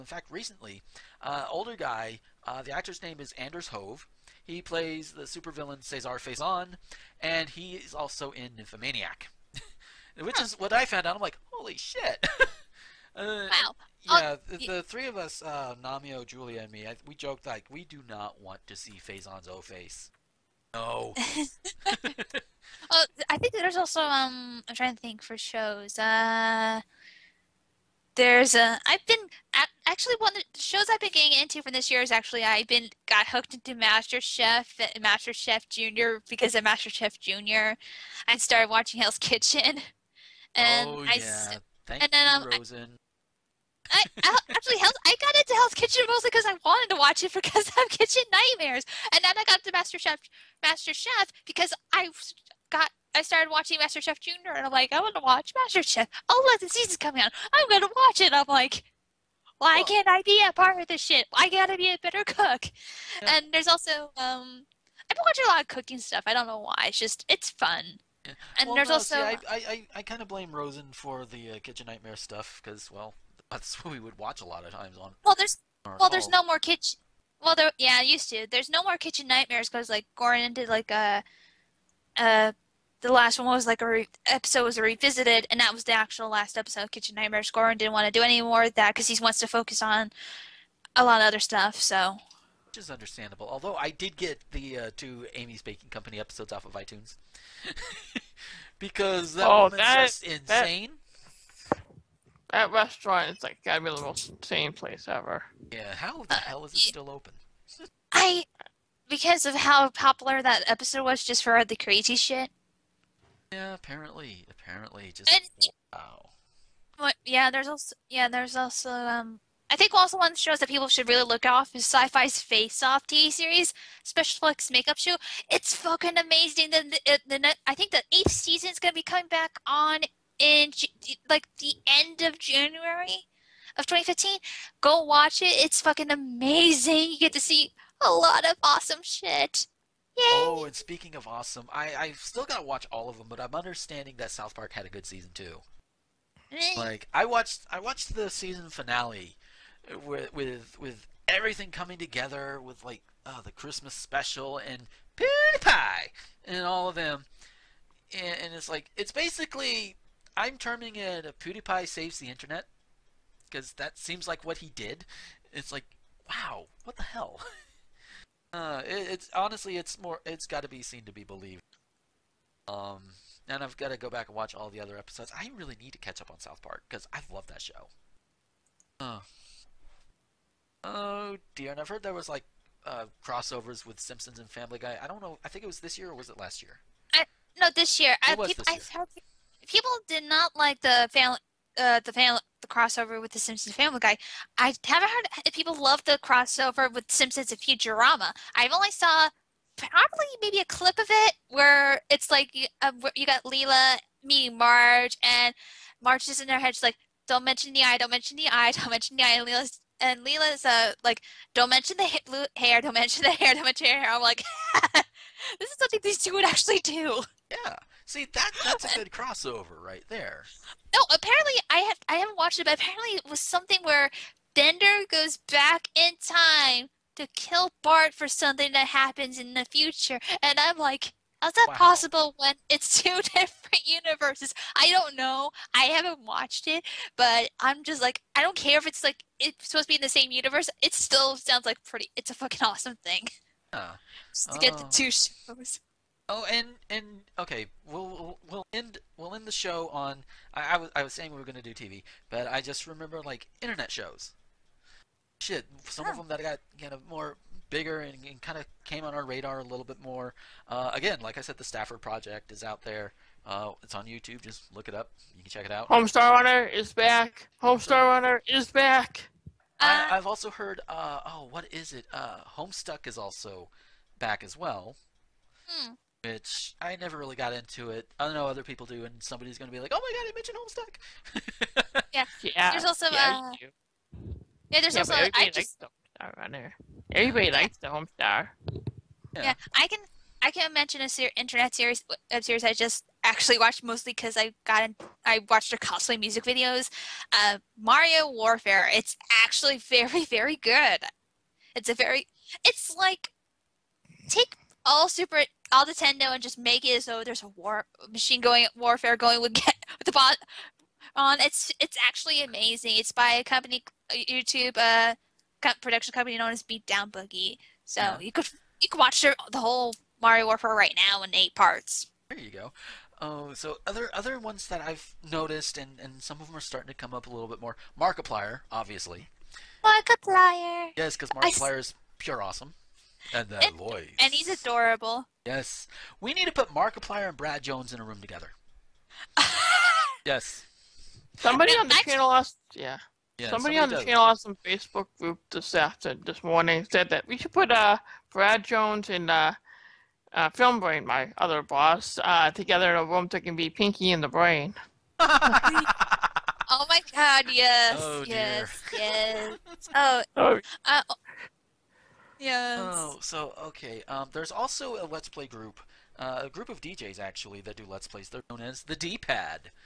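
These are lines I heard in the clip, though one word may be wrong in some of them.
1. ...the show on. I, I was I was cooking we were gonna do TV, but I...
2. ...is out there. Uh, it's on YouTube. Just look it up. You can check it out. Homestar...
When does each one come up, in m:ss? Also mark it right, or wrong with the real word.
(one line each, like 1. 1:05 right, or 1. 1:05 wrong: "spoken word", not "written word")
1. 4:09 wrong: "saying", not "cooking"
2. 4:22 right.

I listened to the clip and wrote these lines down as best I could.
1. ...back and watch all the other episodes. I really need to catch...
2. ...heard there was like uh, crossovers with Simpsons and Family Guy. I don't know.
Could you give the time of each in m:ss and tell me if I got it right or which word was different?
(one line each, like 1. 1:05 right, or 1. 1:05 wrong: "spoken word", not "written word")
1. 2:54 right
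2. 3:01 right.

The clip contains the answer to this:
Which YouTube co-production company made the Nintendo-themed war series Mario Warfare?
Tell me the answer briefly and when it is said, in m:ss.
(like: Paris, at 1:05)
Beatdown Boogie, at 5:16.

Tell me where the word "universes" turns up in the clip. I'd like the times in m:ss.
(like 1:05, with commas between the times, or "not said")
3:53, 4:00.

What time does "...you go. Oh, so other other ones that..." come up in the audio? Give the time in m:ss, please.
5:22.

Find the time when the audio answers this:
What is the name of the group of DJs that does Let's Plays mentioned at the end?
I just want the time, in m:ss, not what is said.
6:08.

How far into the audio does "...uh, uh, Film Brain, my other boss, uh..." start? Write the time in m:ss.
5:49.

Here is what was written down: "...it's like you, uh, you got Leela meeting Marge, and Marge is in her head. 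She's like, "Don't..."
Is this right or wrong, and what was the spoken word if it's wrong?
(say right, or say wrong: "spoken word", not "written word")
right.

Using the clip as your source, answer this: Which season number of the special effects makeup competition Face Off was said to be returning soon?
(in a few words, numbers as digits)
8.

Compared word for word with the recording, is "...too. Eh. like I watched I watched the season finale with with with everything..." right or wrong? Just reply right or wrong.
right.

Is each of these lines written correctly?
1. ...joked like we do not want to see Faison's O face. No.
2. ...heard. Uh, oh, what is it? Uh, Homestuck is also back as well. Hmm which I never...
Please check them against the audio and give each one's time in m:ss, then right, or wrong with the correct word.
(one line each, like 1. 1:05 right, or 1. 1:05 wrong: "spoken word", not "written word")
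1. 0:17 right
2. 4:30 right.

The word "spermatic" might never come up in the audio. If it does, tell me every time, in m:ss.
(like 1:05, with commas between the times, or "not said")
not said.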